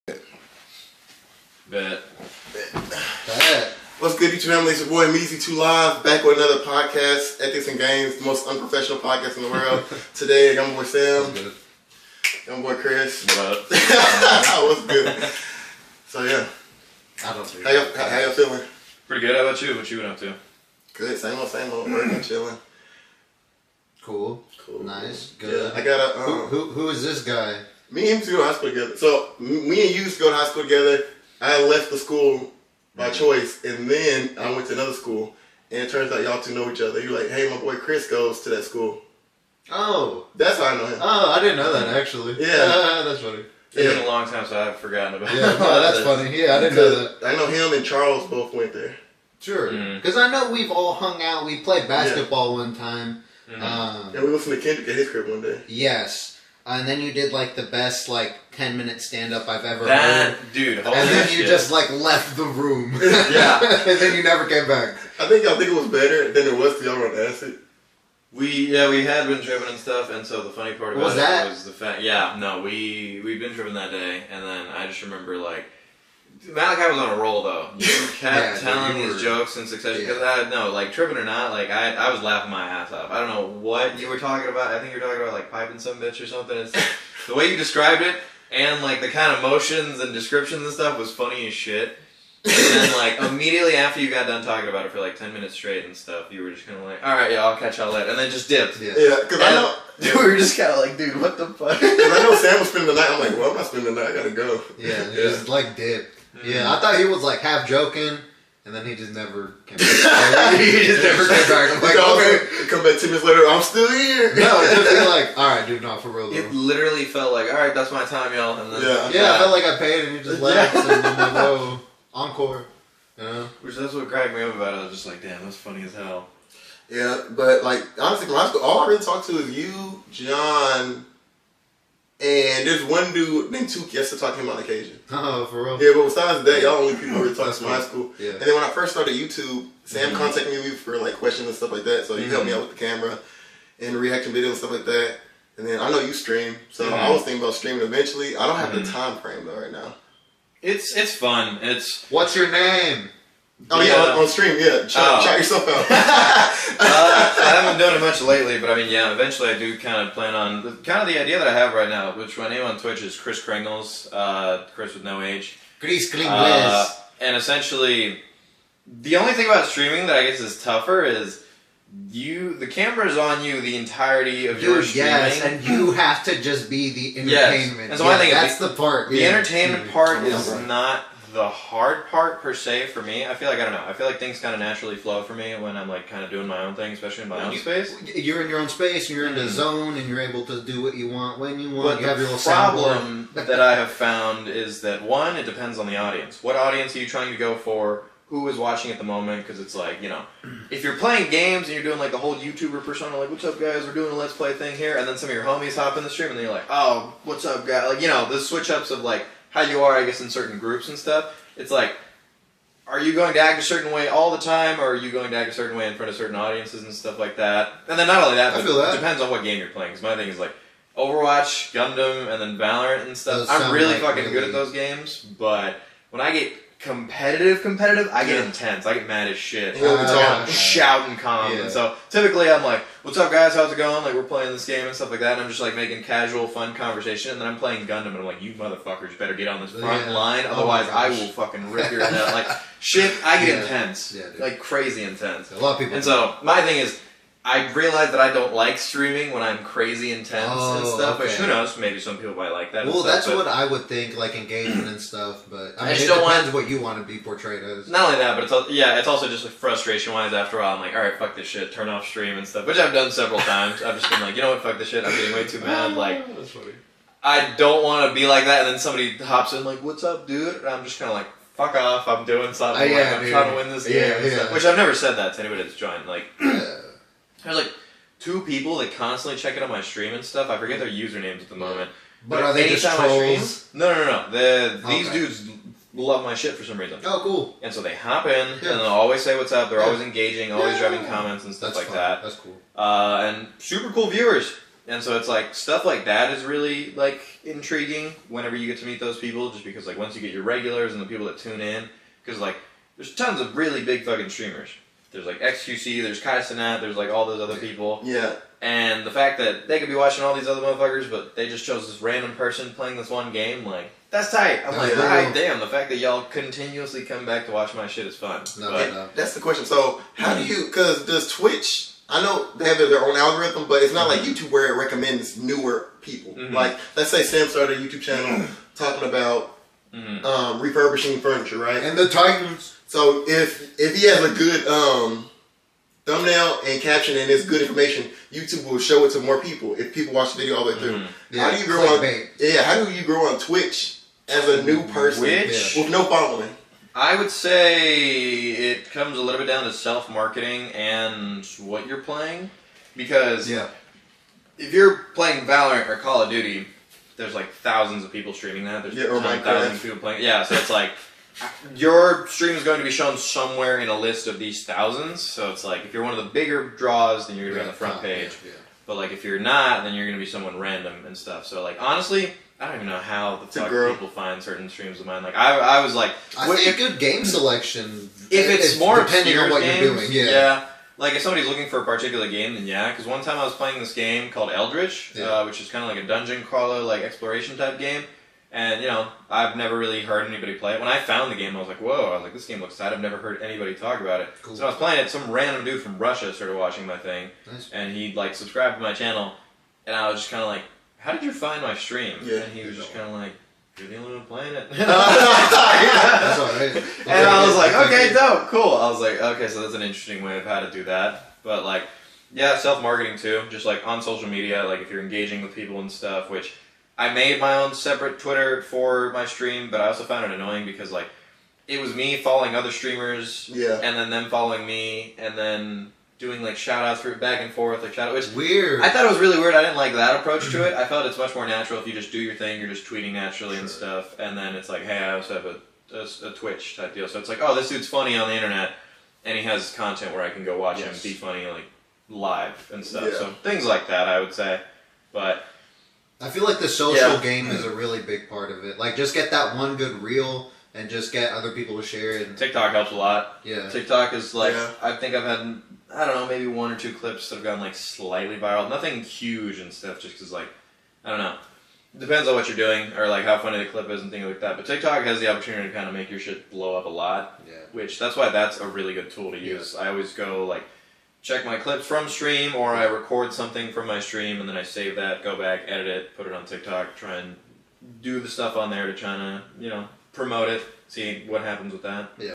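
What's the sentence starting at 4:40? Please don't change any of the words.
I forget their usernames at the moment.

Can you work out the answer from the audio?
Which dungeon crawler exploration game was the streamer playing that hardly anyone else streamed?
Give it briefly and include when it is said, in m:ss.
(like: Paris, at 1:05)
Eldritch, at 6:24.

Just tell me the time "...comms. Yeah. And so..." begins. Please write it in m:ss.
3:51.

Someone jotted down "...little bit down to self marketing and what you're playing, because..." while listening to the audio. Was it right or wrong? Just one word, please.
right.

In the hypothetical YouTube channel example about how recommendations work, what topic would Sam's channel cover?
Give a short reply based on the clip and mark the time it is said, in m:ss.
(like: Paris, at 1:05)
Refurbishing furniture, at 5:30.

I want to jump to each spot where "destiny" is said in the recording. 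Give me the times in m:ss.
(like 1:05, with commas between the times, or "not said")
not said.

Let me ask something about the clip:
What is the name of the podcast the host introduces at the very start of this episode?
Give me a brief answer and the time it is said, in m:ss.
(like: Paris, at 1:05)
Ethics and Games, at 0:07.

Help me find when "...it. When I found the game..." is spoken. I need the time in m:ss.
6:30.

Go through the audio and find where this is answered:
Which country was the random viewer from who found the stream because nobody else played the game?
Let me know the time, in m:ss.
6:35.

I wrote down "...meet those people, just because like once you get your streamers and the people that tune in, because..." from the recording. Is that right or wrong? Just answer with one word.
wrong.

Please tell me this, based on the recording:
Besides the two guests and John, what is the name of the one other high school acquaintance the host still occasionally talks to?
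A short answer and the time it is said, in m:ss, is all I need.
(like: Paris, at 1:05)
Tuke, at 2:13.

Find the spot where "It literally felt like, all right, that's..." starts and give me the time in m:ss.
1:56.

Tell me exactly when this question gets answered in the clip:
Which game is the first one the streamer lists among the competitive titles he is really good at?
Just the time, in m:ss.
3:40.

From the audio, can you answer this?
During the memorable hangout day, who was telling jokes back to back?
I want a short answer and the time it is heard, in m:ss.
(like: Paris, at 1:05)
Malachi, at 1:16.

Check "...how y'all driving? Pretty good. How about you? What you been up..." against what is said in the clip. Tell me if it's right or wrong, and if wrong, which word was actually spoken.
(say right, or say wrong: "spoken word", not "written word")
wrong: "feeling", not "driving".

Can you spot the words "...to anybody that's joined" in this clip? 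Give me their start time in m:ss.
4:35.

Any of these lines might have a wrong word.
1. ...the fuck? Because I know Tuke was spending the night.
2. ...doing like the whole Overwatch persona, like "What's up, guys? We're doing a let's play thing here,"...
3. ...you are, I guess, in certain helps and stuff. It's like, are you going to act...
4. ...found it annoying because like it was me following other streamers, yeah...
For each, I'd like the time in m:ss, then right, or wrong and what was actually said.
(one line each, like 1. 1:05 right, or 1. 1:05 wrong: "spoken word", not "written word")
1. 1:41 wrong: "Sam", not "Tuke"
2. 3:21 wrong: "YouTuber", not "Overwatch"
3. 3:29 wrong: "groups", not "helps"
4. 7:00 right.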